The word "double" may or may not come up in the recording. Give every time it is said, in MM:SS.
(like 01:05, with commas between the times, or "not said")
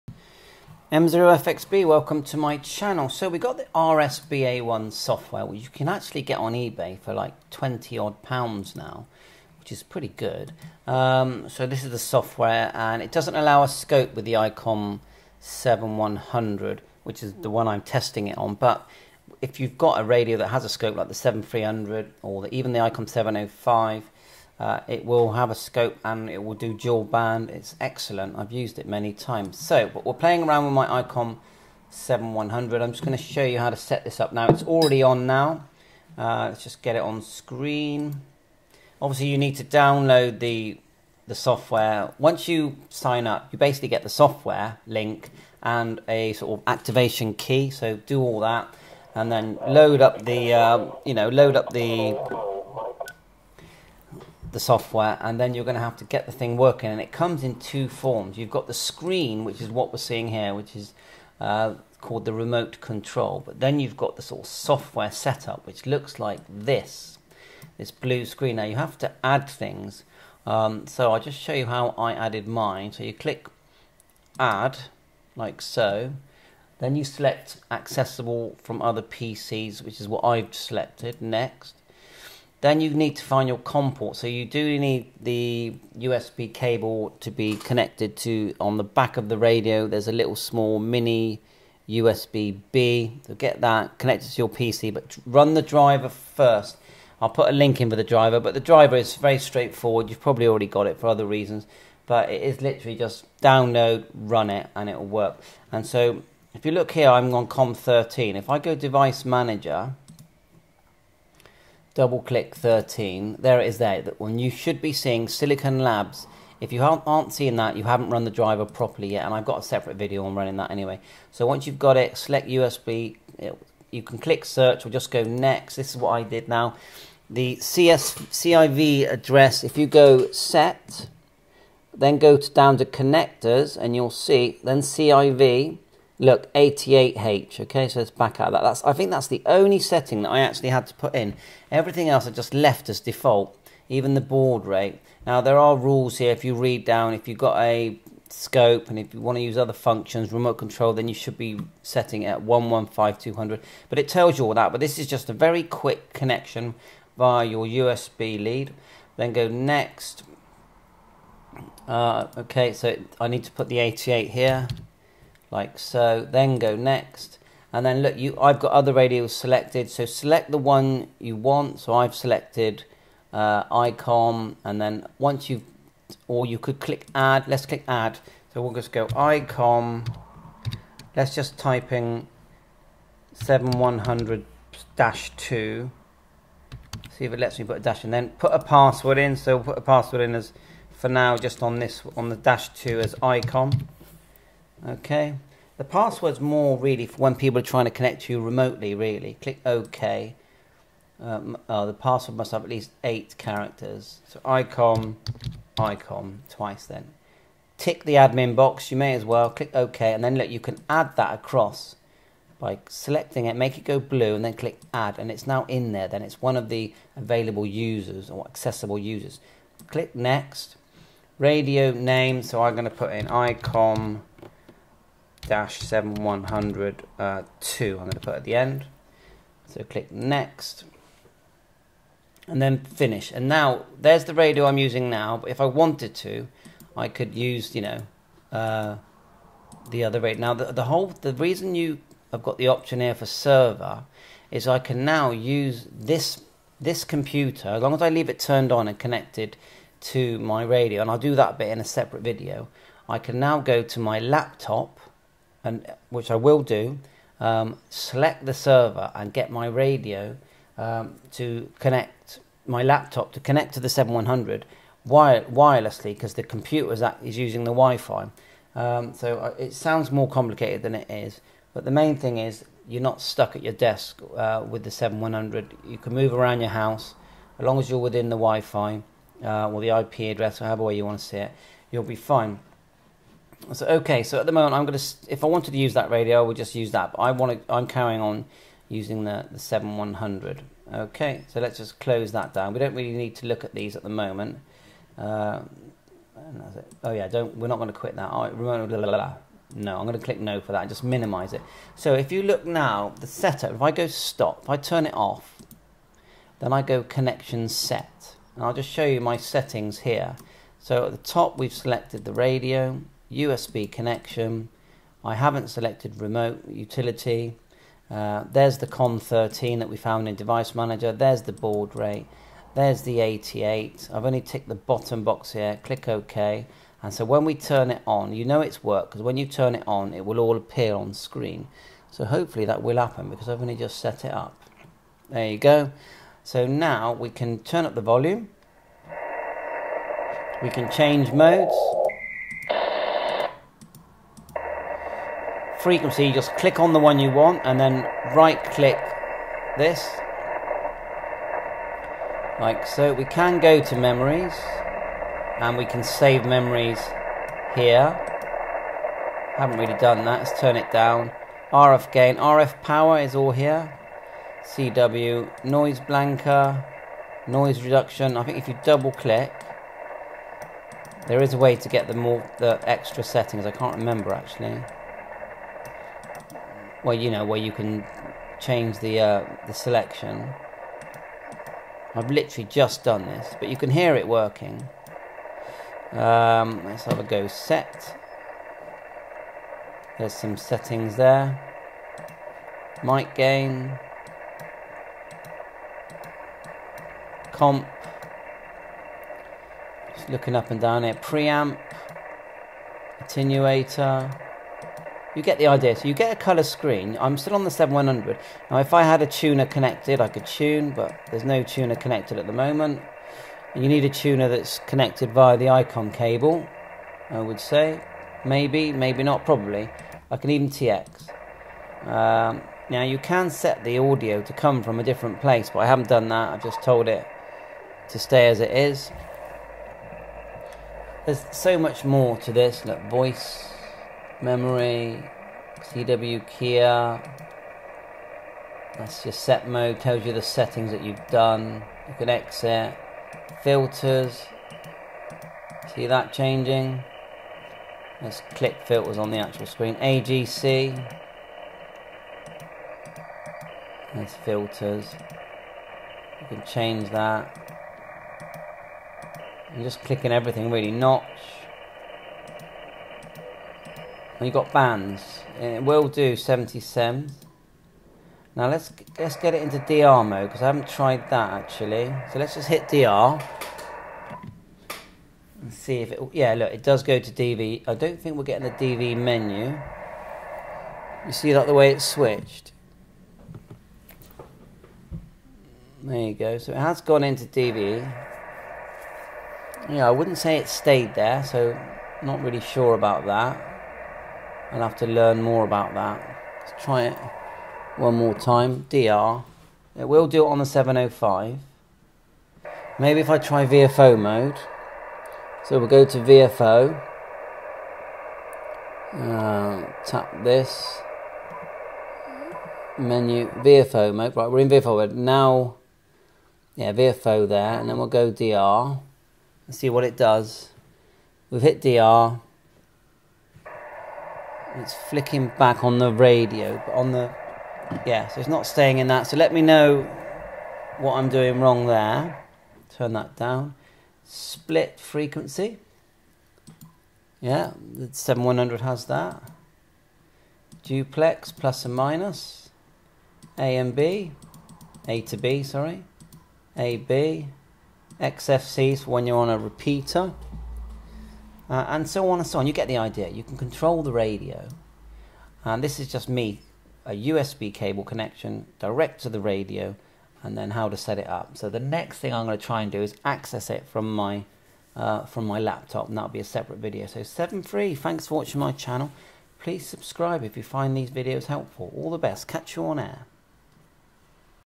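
01:51, 06:08.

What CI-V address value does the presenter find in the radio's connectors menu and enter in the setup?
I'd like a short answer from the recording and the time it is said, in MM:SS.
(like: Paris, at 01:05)
88H, at 02:16.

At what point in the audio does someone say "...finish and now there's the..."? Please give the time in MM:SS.
03:52.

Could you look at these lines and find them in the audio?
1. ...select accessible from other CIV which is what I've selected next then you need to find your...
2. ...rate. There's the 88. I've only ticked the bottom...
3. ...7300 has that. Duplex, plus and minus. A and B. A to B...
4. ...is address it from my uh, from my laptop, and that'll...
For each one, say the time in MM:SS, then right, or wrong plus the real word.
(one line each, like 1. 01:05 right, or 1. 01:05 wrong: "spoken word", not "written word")
1. 01:17 wrong: "PCs", not "CIV"
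2. 05:21 right
3. 08:58 wrong: "7100", not "7300"
4. 09:23 wrong: "access", not "address".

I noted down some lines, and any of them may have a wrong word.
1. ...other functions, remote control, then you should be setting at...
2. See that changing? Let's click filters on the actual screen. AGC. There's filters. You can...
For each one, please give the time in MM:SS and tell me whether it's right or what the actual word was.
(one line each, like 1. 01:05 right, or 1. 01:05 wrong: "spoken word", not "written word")
1. 02:29 right
2. 07:25 right.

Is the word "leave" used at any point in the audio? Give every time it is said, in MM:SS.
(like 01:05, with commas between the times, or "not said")
04:08.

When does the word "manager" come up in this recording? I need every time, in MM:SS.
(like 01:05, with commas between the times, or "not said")
01:49, 05:20.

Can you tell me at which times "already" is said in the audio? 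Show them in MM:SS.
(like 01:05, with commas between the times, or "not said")
00:34, 01:40.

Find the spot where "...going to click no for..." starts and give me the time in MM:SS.
05:00.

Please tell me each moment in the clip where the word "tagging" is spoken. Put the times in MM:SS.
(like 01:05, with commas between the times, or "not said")
not said.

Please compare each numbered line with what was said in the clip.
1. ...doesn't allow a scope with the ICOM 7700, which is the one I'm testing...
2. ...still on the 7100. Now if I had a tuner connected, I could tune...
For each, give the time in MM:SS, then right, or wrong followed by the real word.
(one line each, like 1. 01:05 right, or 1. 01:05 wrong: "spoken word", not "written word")
1. 00:13 wrong: "7100", not "7700"
2. 06:47 right.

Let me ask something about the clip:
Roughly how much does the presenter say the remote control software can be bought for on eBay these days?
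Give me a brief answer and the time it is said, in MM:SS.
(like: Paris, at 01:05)
20 odd pounds, at 00:07.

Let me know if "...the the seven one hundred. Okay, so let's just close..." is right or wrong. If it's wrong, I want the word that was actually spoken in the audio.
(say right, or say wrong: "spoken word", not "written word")
right.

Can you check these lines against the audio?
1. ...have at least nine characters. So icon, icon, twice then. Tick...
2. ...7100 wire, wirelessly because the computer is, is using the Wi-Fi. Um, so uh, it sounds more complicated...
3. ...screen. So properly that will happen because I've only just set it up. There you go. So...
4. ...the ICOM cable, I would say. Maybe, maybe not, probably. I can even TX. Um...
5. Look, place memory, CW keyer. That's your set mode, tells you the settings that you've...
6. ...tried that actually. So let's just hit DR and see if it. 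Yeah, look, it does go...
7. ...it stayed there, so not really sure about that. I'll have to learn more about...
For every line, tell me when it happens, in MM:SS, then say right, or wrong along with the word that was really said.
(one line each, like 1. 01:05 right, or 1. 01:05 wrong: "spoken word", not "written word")
1. 03:22 wrong: "eight", not "nine"
2. 04:23 right
3. 05:31 wrong: "hopefully", not "properly"
4. 06:55 right
5. 07:12 wrong: "voice", not "place"
6. 07:50 right
7. 08:10 right.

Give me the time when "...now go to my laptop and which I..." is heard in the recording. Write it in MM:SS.
04:13.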